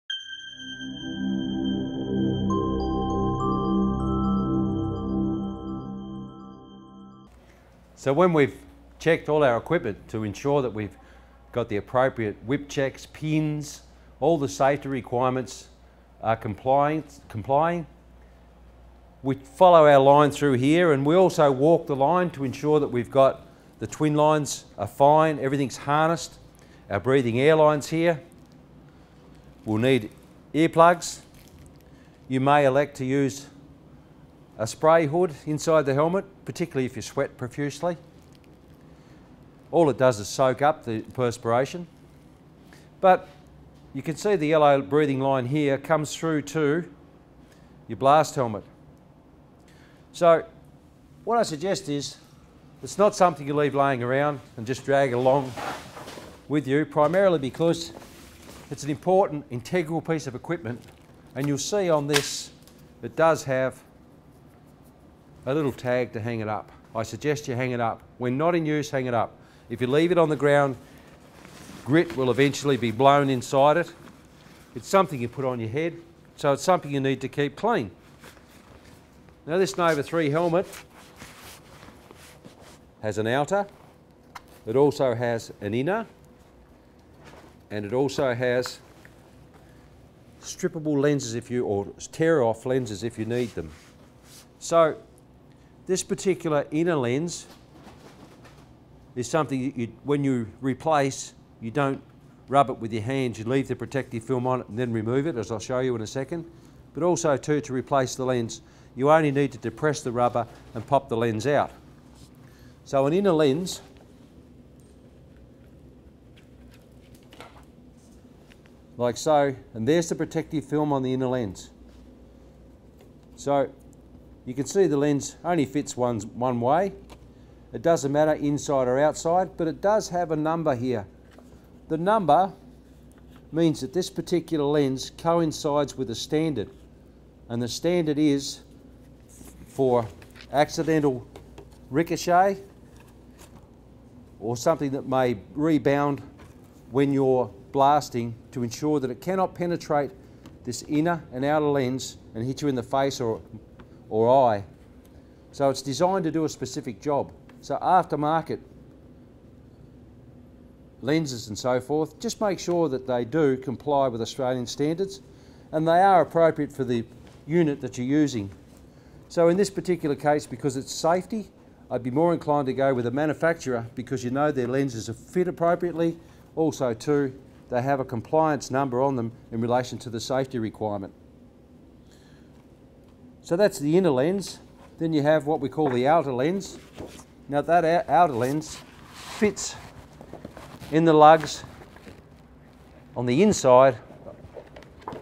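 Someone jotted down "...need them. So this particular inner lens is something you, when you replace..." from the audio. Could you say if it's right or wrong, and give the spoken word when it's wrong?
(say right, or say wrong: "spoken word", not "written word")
right.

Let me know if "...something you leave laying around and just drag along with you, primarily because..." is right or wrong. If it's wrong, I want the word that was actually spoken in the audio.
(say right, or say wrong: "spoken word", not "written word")
right.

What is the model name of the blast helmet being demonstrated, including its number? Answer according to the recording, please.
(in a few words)
Nova 3.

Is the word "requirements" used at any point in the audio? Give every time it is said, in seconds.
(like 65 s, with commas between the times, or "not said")
14 s, 180 s.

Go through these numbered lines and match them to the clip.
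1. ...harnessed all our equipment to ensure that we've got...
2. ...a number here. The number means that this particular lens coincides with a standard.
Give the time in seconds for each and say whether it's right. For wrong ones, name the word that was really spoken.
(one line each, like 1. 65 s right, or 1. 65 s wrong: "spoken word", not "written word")
1. 8 s wrong: "checked", not "harnessed"
2. 130 s right.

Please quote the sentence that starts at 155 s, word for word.
So it's designed to do a specific job.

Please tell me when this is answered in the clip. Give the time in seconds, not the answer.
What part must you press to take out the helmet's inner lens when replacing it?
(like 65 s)
110 s.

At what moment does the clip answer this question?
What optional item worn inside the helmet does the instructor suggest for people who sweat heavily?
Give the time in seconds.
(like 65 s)
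34 s.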